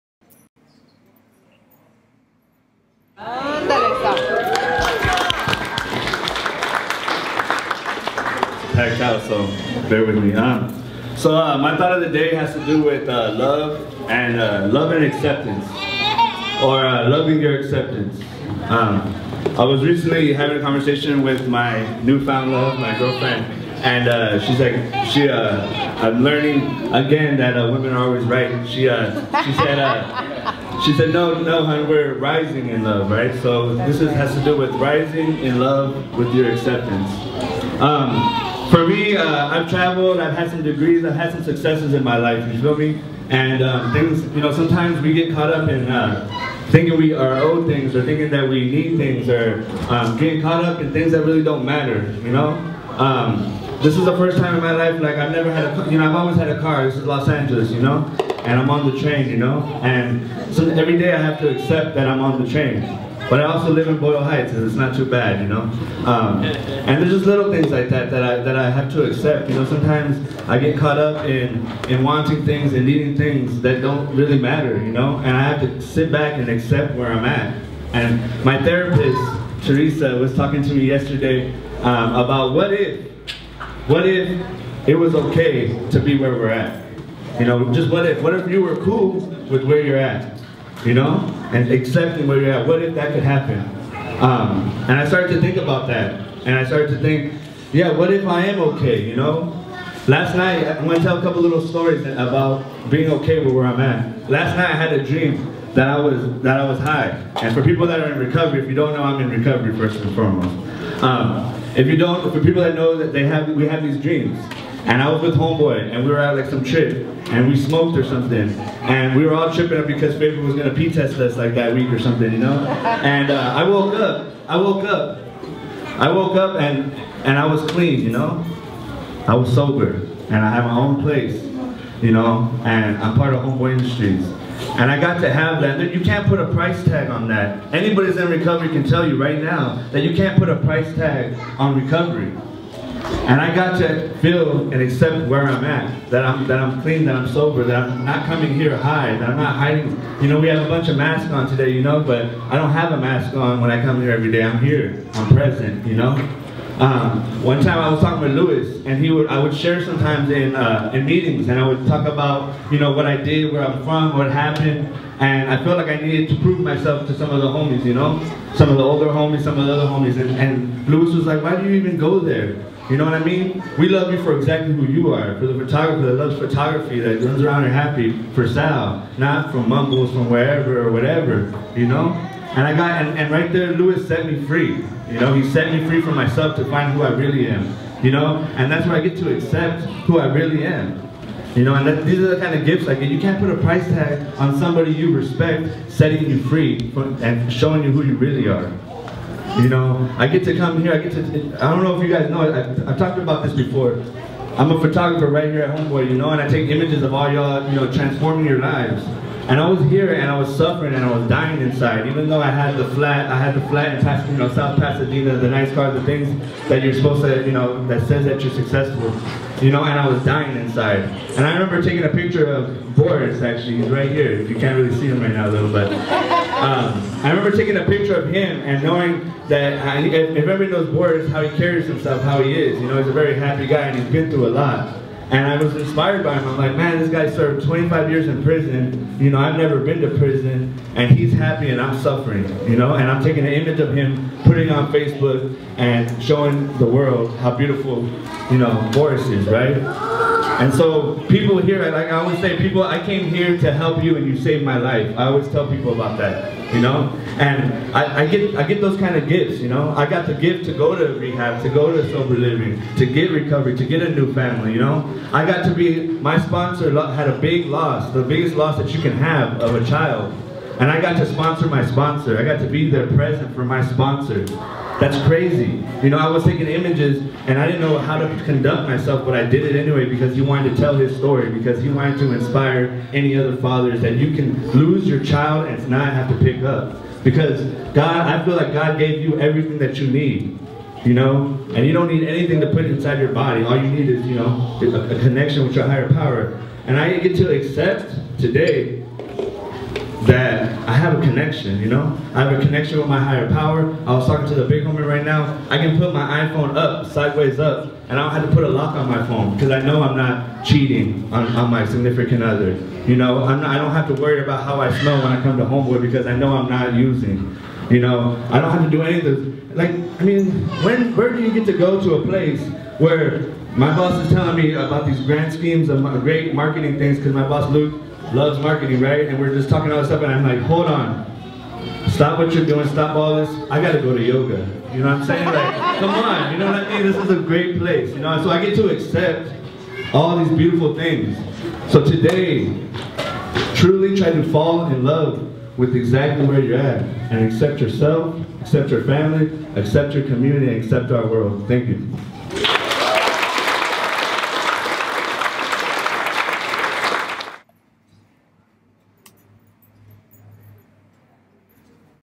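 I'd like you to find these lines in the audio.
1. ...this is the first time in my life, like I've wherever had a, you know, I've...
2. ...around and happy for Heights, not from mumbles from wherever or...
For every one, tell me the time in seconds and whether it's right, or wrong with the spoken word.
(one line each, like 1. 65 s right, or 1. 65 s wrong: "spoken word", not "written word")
1. 53 s wrong: "never", not "wherever"
2. 177 s wrong: "Sal", not "Heights".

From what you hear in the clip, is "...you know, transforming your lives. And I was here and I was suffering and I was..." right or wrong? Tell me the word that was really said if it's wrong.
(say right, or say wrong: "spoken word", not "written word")
right.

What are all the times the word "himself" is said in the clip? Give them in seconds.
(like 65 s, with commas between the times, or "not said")
231 s.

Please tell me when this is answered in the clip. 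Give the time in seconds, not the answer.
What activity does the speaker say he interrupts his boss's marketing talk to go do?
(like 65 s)
334 s.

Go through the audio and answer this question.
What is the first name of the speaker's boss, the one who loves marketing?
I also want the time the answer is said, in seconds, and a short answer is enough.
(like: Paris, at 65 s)
Luke, at 327 s.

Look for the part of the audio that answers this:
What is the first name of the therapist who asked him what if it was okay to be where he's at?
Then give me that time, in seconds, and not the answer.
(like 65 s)
79 s.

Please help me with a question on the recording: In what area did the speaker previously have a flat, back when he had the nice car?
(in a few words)
South Pasadena.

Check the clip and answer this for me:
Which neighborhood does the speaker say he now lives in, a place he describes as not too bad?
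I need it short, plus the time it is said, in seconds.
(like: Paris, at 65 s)
Boyle Heights, at 63 s.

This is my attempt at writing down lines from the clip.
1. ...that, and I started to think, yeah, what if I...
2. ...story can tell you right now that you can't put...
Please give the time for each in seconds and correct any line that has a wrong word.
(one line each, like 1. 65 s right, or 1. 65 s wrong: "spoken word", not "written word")
1. 95 s right
2. 138 s wrong: "recovery", not "story".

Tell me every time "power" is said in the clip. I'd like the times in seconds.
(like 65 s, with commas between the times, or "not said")
296 s, 303 s.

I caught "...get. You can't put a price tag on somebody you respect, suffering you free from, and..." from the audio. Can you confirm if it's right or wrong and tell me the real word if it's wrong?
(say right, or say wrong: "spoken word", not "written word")
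wrong: "setting", not "suffering".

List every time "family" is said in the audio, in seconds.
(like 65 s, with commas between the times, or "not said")
264 s, 349 s.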